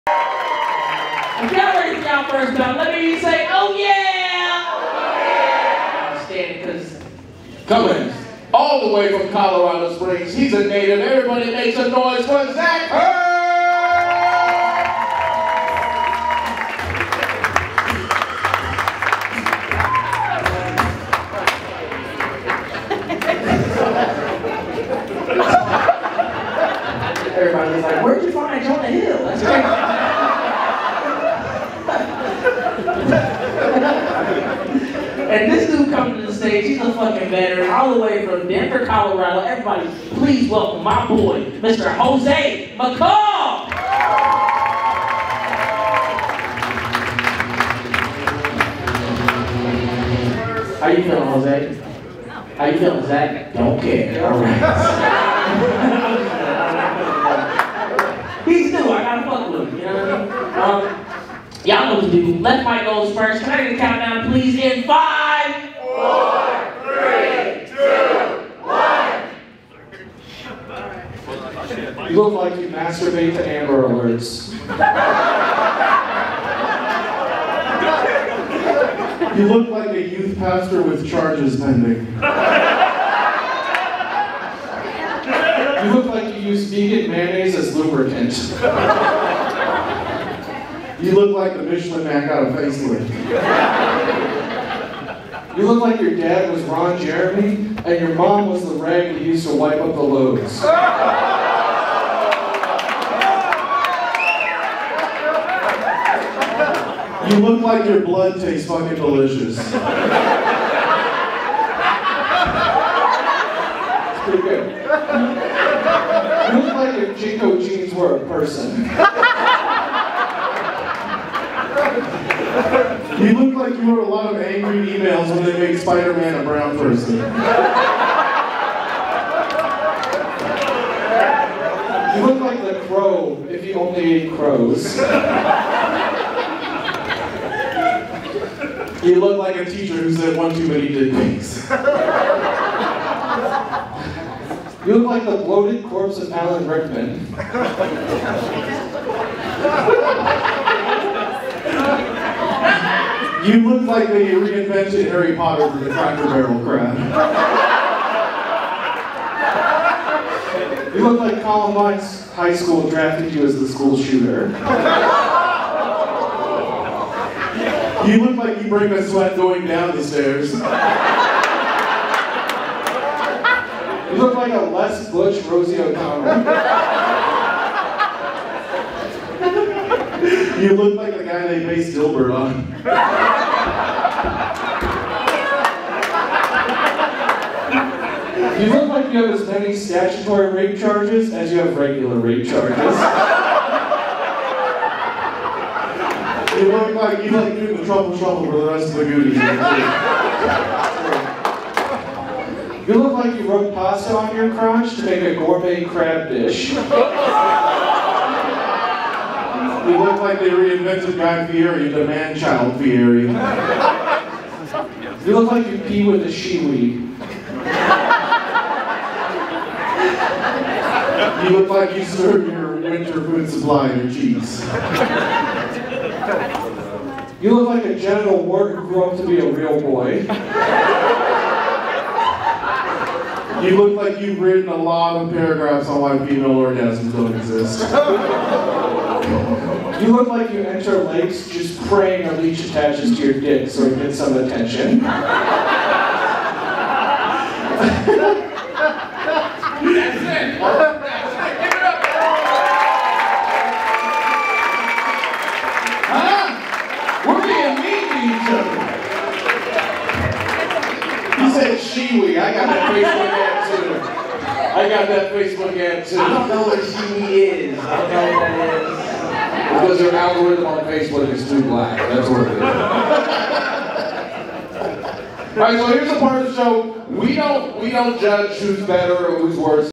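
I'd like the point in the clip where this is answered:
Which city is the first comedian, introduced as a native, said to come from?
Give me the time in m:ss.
0:09.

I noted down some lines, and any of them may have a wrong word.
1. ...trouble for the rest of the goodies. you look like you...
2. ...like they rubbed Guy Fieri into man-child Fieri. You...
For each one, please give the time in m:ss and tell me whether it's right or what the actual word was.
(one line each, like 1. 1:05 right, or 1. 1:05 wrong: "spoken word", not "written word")
1. 3:18 right
2. 3:30 wrong: "reinvented", not "rubbed".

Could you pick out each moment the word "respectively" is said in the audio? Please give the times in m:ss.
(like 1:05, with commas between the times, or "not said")
not said.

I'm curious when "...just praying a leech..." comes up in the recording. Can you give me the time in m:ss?
4:01.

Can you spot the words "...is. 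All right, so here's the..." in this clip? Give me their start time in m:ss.
4:32.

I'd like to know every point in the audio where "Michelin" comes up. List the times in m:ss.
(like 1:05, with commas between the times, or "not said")
1:31.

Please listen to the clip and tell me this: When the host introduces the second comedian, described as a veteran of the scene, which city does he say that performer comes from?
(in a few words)
Denver.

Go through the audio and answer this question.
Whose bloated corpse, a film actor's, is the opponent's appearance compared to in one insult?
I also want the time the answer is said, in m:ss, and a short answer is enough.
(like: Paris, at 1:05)
Alan Rickman, at 2:26.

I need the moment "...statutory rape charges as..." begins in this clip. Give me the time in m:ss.
3:09.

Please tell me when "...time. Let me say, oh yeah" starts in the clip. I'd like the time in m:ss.
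0:02.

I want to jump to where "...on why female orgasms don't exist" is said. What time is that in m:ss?
3:55.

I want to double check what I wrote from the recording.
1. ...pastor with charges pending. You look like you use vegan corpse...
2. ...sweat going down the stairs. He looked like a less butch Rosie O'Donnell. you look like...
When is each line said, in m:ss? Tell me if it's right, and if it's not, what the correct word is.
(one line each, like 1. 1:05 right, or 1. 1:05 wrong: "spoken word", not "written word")
1. 1:20 wrong: "mayonnaise", not "corpse"
2. 2:49 right.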